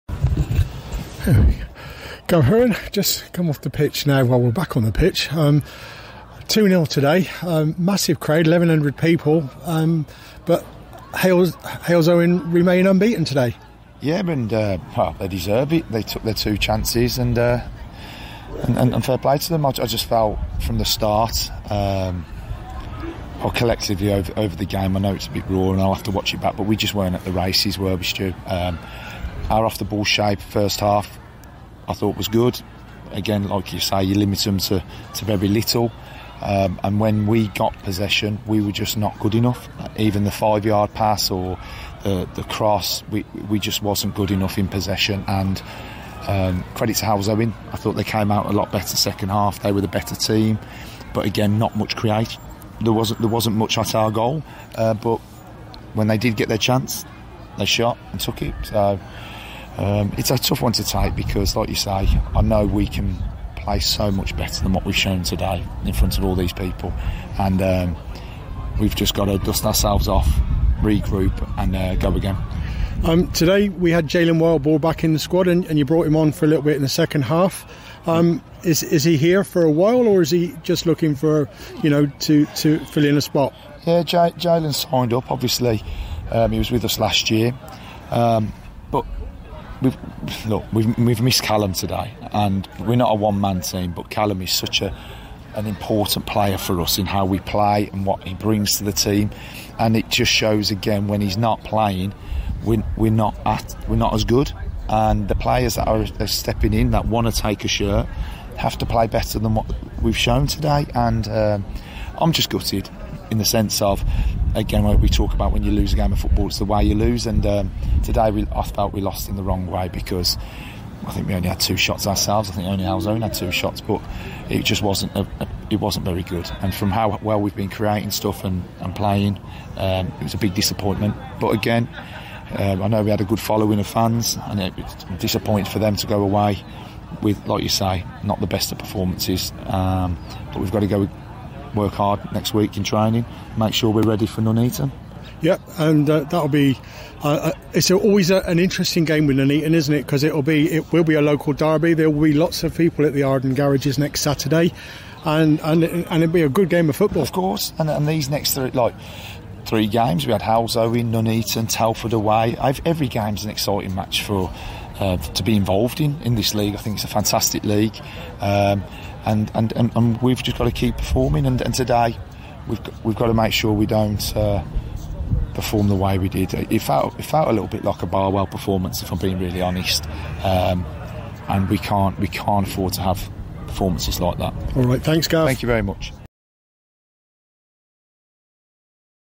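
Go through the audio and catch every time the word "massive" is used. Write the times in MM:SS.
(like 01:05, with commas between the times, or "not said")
00:07.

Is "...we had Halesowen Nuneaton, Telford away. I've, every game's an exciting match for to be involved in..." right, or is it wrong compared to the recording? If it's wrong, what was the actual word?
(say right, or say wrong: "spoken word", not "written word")
right.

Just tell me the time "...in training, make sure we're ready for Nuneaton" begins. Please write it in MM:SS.
02:22.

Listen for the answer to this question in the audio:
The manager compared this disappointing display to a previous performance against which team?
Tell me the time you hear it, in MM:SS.
02:58.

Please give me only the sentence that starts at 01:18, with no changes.
Um, is is he here for a while, or is he just looking for you know to to fill in a spot?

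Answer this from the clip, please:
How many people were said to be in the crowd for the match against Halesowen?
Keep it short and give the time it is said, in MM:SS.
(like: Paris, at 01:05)
1,100, at 00:08.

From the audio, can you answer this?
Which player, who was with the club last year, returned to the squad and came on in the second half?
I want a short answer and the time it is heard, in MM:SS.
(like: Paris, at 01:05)
Jalen Wildball, at 01:14.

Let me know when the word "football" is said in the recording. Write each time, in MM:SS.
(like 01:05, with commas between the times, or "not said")
01:56, 02:36.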